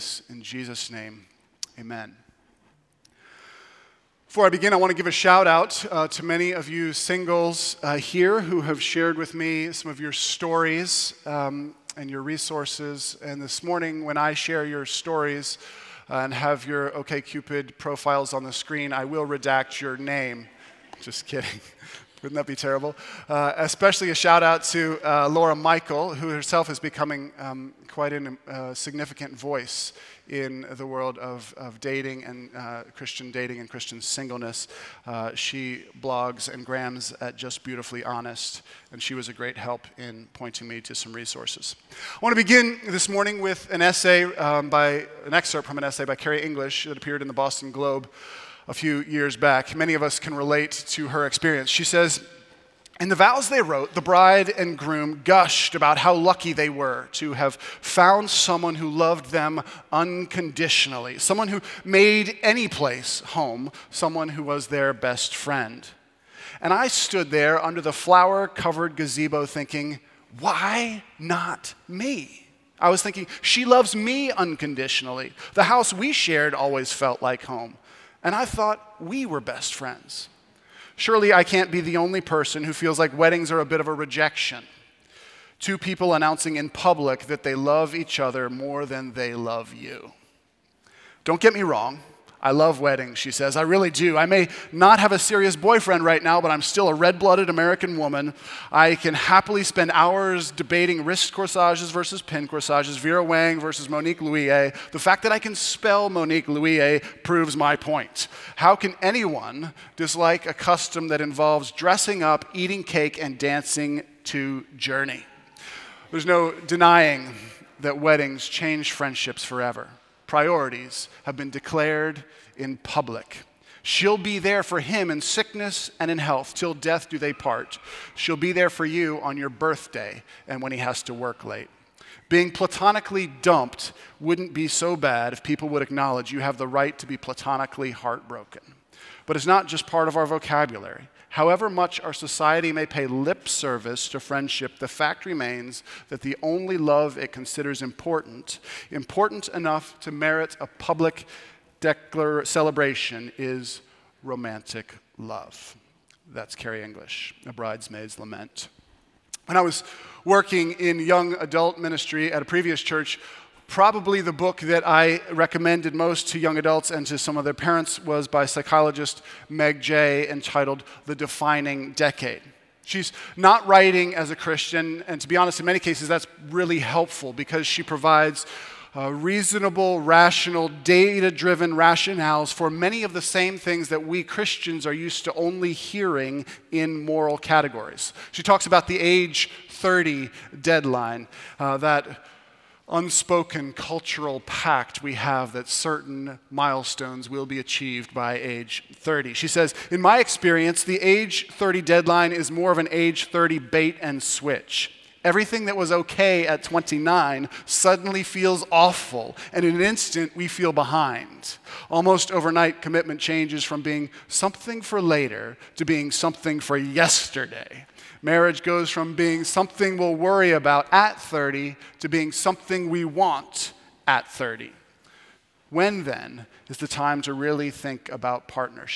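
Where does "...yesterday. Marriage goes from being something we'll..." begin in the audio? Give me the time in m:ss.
3:36.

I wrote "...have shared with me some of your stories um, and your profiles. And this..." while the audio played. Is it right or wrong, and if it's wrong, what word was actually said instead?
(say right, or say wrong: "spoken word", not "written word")
wrong: "resources", not "profiles".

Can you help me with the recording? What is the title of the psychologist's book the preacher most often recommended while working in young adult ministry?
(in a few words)
The Defining Decade.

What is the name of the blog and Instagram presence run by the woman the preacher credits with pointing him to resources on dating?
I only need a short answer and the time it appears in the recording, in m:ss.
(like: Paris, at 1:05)
Just Beautifully Honest, at 0:37.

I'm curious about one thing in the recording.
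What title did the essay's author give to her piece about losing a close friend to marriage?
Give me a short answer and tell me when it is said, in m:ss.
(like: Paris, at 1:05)
A Bridesmaid's Lament, at 2:37.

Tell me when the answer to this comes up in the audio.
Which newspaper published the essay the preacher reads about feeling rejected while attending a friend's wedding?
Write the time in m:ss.
0:47.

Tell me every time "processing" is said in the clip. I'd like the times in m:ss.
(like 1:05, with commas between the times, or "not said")
not said.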